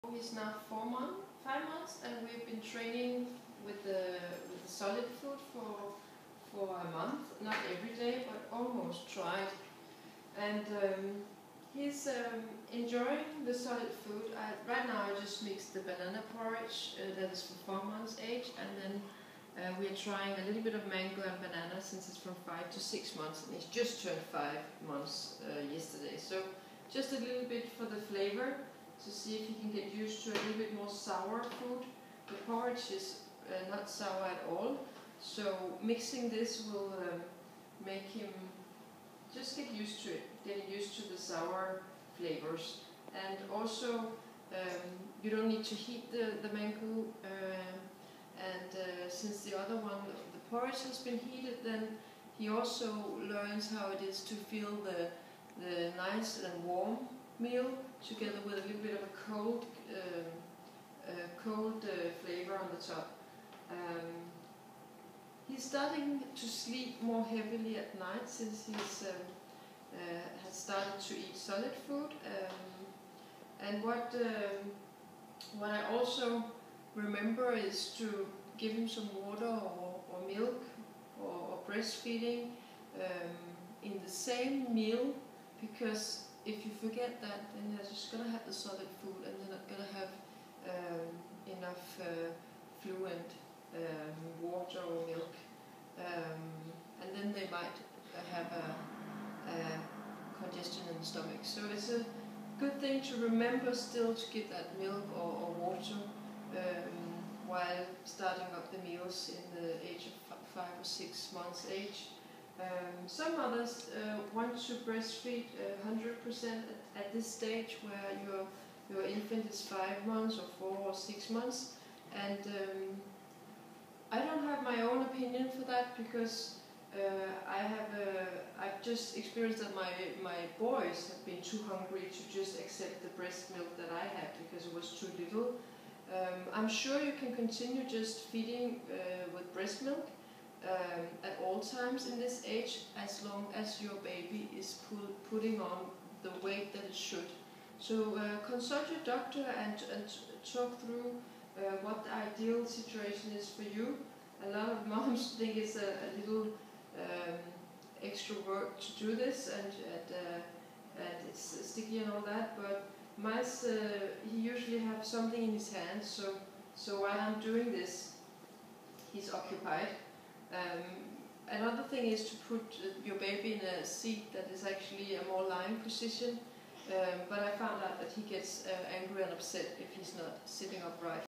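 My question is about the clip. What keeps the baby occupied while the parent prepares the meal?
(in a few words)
something in his hand.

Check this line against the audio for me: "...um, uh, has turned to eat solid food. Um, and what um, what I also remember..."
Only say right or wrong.
wrong.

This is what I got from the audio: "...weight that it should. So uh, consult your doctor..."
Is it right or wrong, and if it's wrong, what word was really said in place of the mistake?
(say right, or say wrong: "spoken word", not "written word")
right.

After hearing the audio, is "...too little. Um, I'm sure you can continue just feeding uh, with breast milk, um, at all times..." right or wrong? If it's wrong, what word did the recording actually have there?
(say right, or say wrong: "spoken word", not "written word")
right.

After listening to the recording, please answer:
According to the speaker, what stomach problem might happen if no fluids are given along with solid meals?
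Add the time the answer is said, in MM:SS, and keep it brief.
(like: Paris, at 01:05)
congestion, at 01:40.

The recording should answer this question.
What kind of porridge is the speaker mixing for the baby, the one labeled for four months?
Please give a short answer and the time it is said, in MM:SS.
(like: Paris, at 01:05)
banana porridge, at 00:15.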